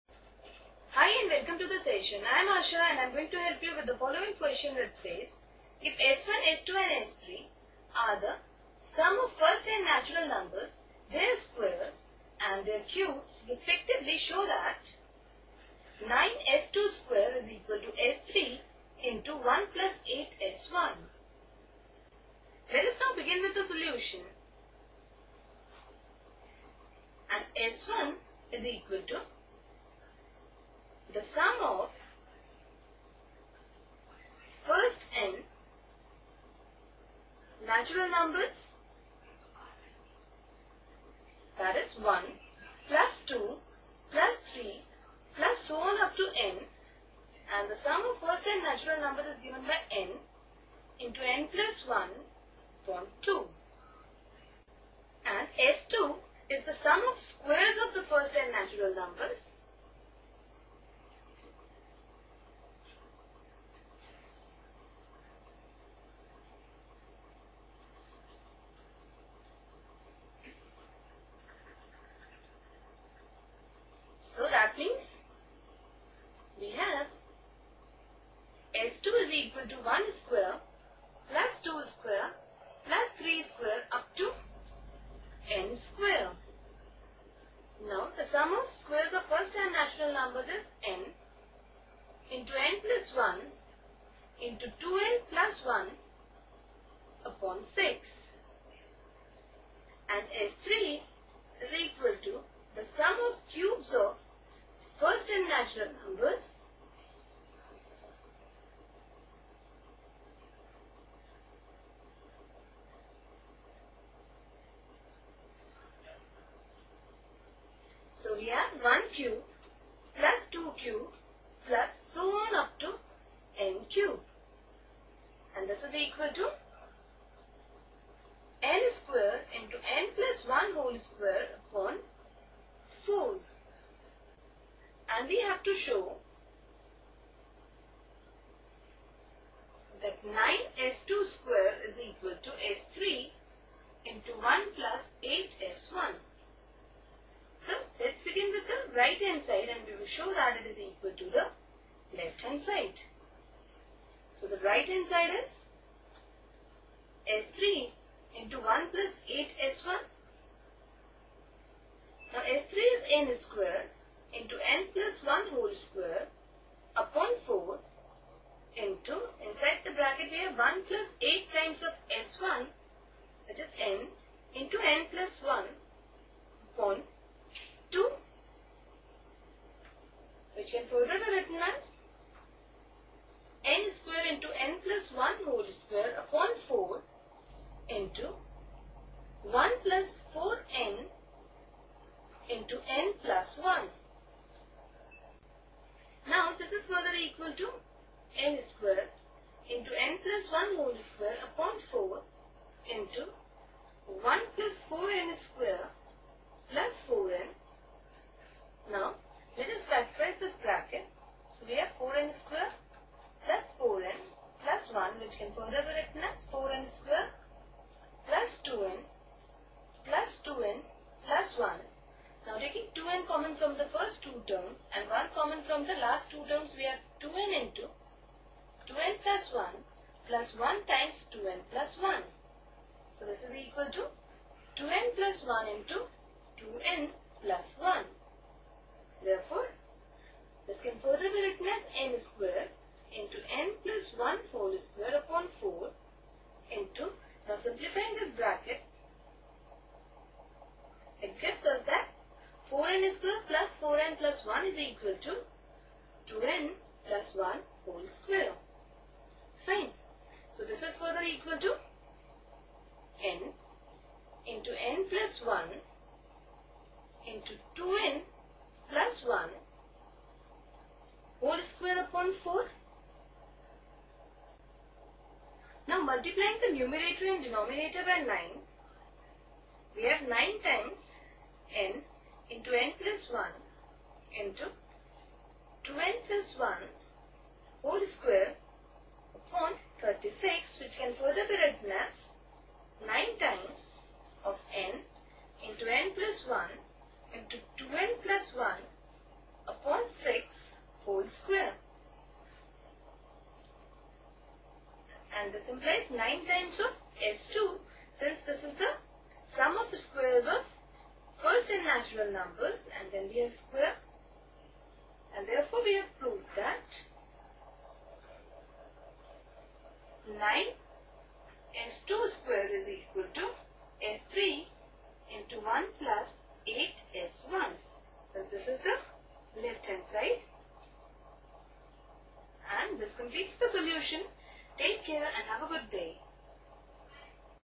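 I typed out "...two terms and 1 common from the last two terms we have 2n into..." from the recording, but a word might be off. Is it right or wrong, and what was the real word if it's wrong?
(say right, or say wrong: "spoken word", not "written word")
right.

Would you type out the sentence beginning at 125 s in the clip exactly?
And this is equal to n square into n plus 1 whole square upon 4.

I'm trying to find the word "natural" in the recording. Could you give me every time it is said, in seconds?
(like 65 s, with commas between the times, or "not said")
9 s, 37 s, 48 s, 58 s, 89 s, 105 s, 311 s.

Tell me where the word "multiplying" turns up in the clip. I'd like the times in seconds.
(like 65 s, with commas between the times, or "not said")
276 s.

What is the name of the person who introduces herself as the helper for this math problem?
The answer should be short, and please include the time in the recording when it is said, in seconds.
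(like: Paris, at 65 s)
Asha, at 2 s.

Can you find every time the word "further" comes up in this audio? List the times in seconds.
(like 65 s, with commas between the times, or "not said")
180 s, 196 s, 215 s, 240 s, 260 s, 291 s.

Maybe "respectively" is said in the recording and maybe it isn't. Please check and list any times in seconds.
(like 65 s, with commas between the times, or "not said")
13 s.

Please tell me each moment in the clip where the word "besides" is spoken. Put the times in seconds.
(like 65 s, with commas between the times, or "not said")
not said.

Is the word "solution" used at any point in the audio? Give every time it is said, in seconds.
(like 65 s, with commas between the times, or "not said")
23 s, 333 s.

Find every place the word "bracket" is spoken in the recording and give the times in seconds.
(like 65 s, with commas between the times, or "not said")
169 s, 210 s, 248 s.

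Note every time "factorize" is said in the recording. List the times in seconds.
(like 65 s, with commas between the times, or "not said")
209 s.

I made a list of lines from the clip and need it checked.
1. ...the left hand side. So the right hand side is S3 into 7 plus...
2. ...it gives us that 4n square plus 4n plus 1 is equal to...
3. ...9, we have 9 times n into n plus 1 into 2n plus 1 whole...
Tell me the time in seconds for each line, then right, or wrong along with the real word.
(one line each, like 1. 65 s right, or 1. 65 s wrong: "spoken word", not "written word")
1. 151 s wrong: "1", not "7"
2. 251 s right
3. 278 s right.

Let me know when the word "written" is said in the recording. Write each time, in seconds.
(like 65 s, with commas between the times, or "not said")
181 s, 215 s, 241 s, 291 s.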